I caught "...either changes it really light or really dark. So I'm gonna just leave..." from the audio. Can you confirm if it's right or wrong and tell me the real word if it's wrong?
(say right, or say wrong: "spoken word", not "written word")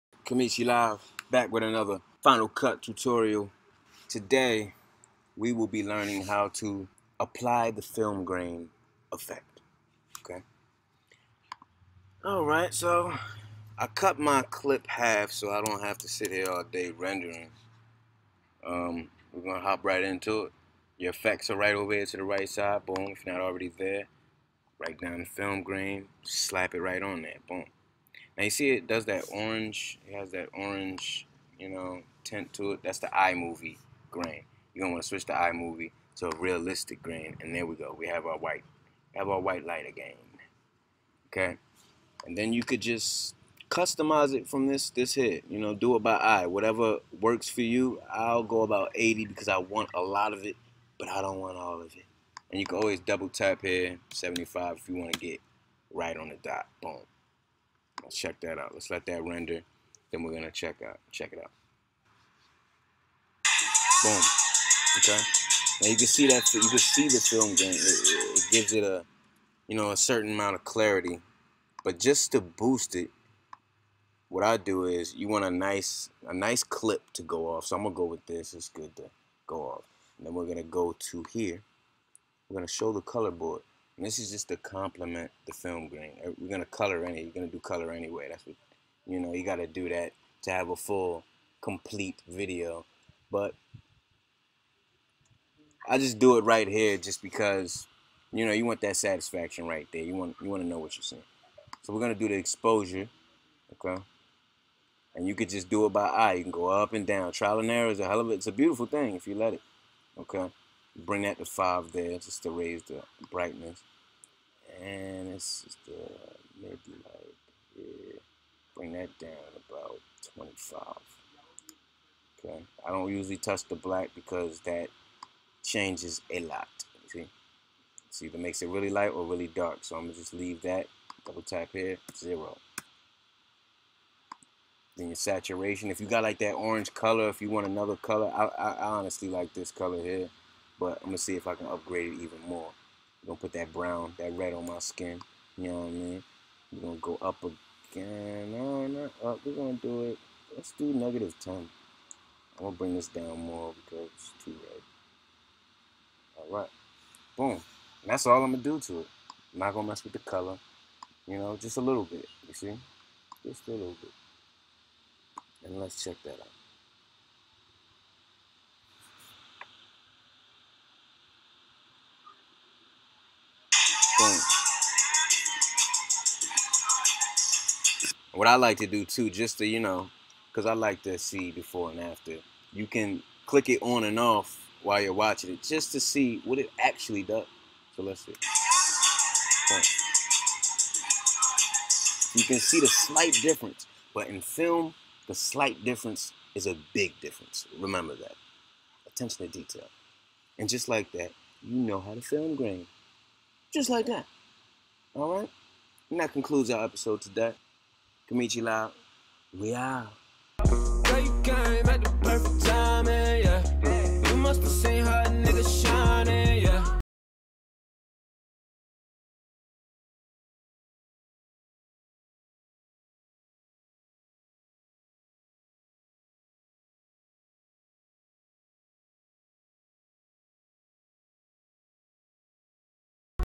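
wrong: "makes", not "changes".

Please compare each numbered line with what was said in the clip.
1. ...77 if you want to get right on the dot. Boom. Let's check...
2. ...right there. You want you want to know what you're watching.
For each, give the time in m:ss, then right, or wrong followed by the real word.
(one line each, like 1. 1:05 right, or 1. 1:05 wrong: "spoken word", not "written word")
1. 0:54 wrong: "75", not "77"
2. 1:39 wrong: "seeing", not "watching".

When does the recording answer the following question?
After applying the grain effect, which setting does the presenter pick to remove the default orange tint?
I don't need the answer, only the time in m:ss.
0:36.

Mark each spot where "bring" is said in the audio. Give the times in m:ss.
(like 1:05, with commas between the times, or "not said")
1:50, 1:58, 2:32.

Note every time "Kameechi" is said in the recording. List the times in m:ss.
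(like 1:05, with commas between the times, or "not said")
0:00, 3:28.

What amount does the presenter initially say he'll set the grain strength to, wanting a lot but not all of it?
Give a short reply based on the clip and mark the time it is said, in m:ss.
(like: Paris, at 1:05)
80, at 0:48.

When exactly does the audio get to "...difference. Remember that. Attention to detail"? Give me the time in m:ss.
3:17.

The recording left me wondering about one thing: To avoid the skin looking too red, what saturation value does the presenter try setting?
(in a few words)
-10.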